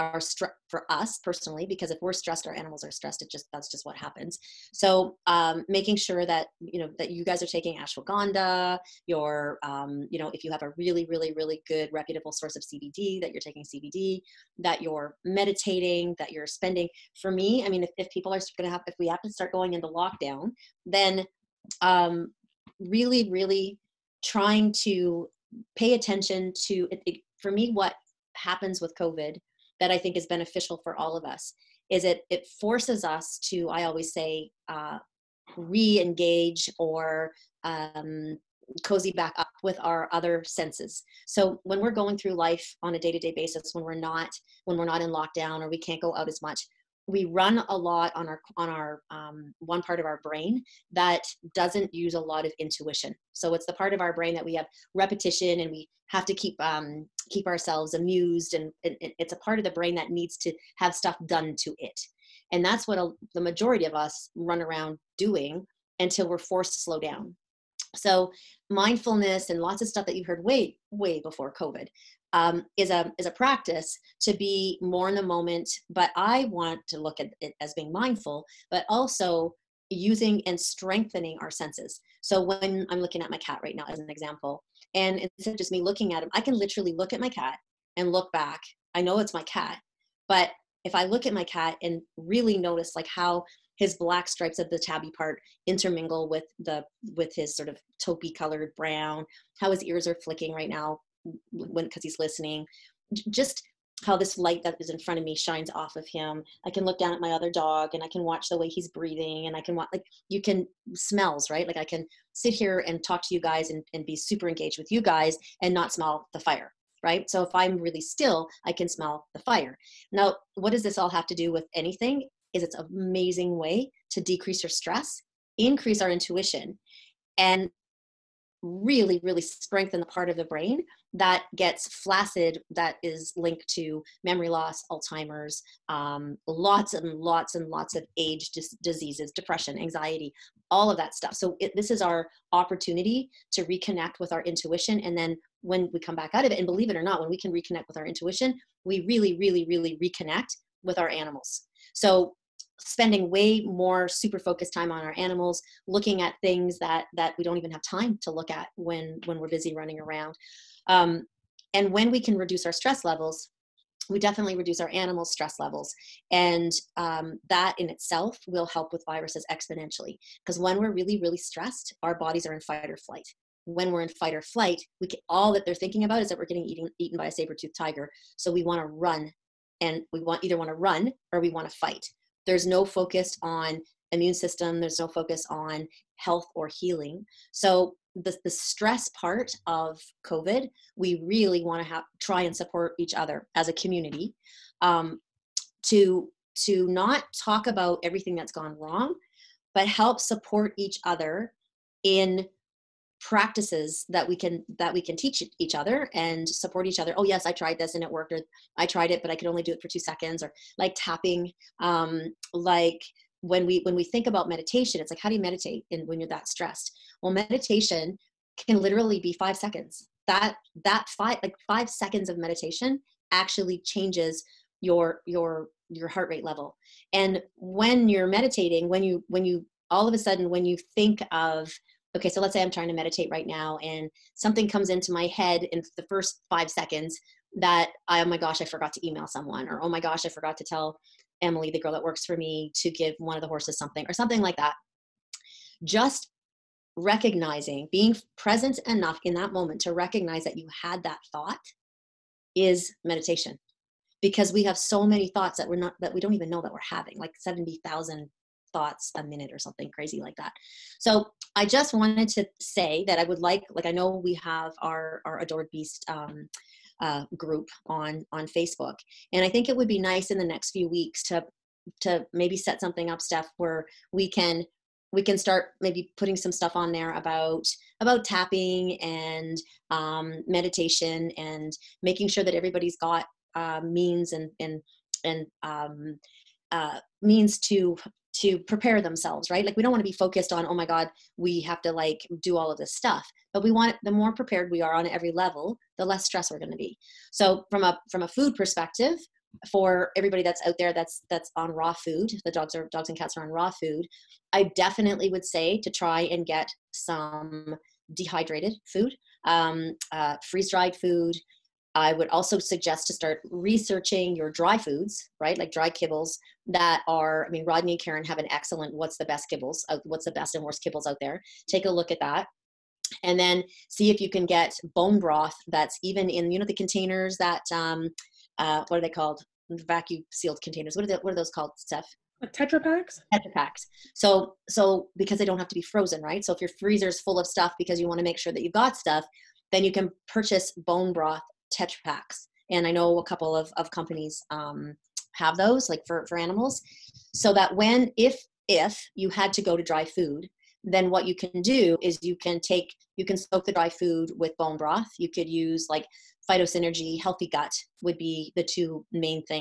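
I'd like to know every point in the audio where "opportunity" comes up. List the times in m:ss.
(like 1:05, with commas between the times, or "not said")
2:22.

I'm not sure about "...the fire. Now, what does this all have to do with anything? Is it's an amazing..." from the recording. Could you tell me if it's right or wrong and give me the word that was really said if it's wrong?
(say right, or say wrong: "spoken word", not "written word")
right.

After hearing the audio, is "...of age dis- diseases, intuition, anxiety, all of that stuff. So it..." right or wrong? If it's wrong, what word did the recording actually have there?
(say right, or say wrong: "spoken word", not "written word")
wrong: "depression", not "intuition".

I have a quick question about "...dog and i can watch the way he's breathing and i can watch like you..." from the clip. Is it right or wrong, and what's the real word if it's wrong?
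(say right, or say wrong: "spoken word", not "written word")
right.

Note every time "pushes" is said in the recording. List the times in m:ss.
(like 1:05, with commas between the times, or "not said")
not said.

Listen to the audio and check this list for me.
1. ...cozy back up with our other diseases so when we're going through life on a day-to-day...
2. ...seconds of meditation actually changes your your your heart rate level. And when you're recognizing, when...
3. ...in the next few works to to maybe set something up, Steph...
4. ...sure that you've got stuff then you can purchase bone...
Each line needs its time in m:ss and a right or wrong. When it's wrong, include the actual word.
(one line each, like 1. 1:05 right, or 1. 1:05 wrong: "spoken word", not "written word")
1. 0:38 wrong: "senses", not "diseases"
2. 3:41 wrong: "meditating", not "recognizing"
3. 4:30 wrong: "weeks", not "works"
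4. 5:38 right.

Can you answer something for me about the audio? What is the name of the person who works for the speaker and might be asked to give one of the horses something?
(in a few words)
Emily.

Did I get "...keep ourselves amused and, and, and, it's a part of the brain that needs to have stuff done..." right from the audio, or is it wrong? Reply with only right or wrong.
right.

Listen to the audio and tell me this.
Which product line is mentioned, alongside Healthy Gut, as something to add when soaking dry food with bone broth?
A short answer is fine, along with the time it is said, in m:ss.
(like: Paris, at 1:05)
Phytosynergy, at 5:56.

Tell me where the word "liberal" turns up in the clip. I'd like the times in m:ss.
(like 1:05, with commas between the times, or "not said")
not said.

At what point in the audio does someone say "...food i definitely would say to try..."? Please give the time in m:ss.
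5:03.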